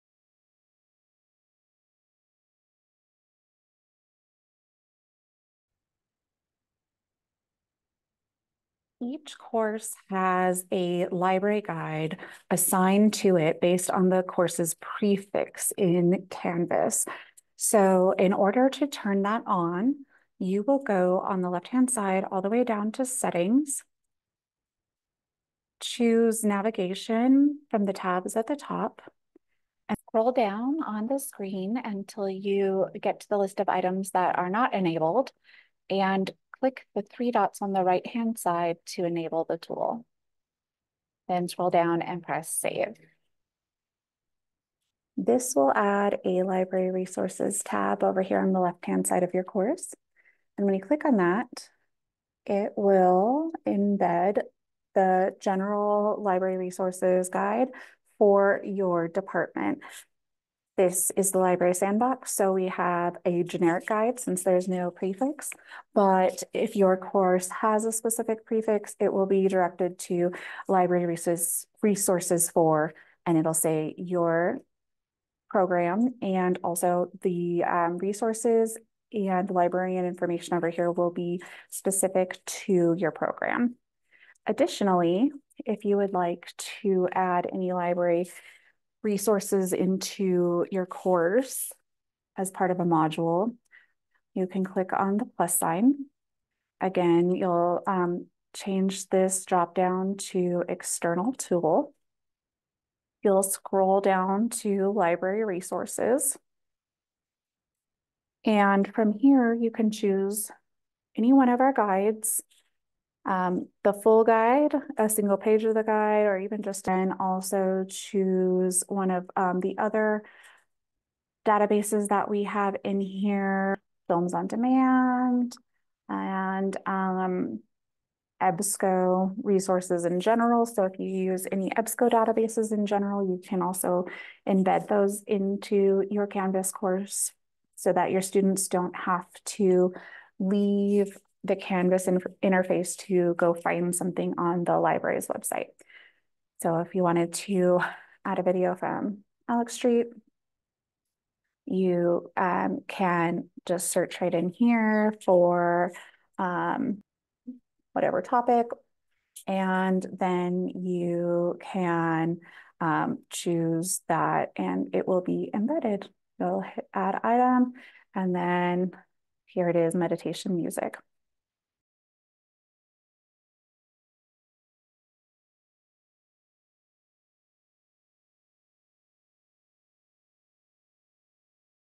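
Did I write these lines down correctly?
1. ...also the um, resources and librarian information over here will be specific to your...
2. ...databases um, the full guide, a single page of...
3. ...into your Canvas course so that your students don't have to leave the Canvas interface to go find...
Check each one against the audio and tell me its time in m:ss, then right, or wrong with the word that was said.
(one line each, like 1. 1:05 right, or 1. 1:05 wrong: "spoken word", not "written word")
1. 1:16 right
2. 1:51 wrong: "guides", not "databases"
3. 2:15 right.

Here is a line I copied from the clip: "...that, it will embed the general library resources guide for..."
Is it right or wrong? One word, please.
right.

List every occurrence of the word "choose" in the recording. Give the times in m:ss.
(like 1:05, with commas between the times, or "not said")
0:25, 1:49, 1:57, 2:43.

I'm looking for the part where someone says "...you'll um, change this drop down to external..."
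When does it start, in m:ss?
1:37.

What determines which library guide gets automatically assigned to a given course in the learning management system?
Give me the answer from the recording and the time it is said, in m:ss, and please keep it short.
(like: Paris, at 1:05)
The course's prefix, at 0:14.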